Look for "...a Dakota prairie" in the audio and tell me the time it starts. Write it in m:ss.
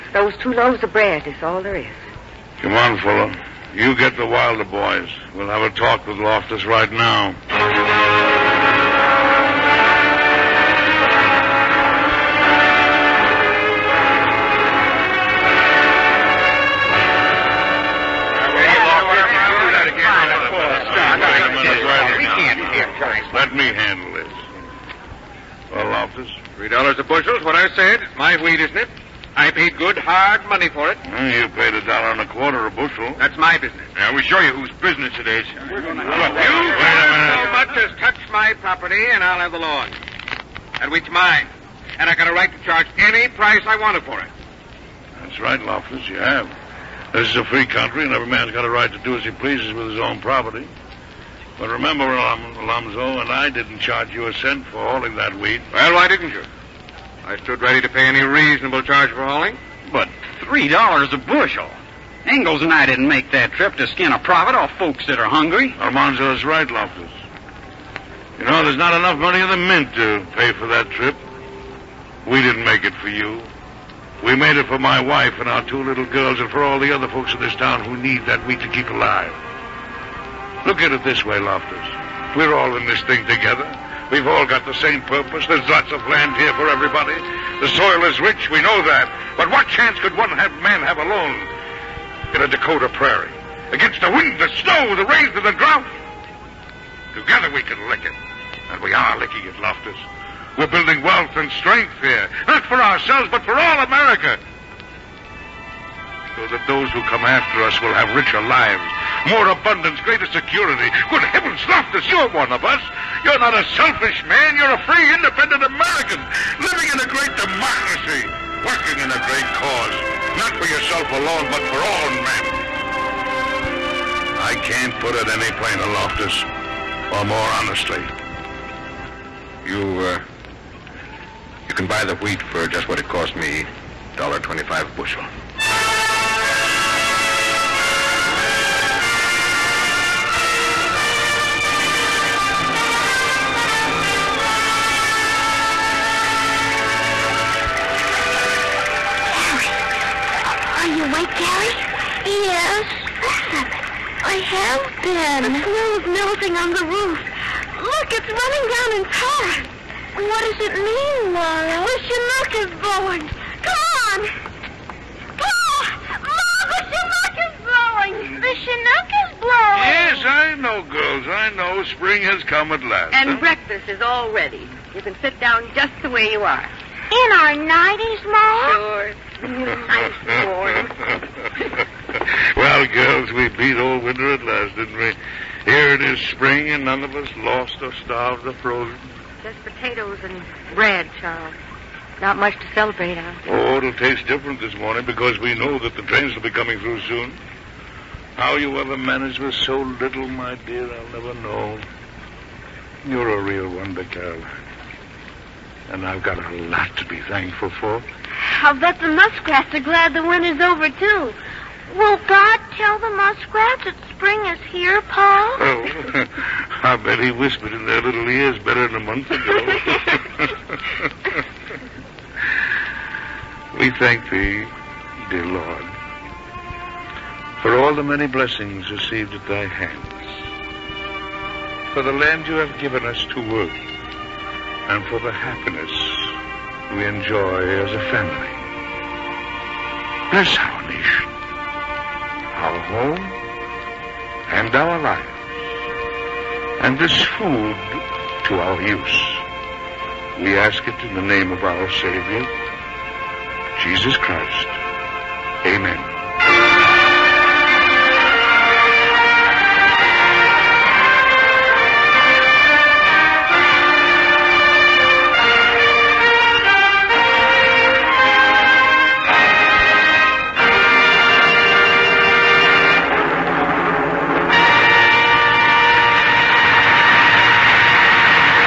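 1:32.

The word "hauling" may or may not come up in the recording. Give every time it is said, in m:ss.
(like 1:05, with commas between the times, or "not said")
0:54, 0:59.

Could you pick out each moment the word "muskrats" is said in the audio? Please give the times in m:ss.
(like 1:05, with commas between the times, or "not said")
3:29, 3:33.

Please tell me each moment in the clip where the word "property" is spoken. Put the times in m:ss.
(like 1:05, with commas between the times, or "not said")
0:38, 0:50.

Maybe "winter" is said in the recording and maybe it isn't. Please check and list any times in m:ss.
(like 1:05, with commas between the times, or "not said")
3:04, 3:30.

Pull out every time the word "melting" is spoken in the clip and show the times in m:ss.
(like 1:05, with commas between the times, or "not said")
2:36.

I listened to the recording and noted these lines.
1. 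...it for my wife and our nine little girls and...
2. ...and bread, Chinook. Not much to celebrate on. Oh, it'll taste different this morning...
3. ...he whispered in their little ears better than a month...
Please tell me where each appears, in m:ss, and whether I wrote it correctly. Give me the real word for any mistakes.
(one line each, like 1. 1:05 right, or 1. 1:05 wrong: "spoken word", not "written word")
1. 1:14 wrong: "two", not "nine"
2. 3:10 wrong: "Charles", not "Chinook"
3. 3:37 right.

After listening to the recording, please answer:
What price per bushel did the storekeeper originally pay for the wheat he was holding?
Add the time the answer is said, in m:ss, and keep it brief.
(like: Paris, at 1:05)
$1.25, at 0:31.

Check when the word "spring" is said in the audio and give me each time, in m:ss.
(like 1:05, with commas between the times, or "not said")
2:51, 3:06, 3:34.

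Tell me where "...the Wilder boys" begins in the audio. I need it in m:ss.
0:04.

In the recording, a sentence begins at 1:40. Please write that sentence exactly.
We're building wealth and strength here.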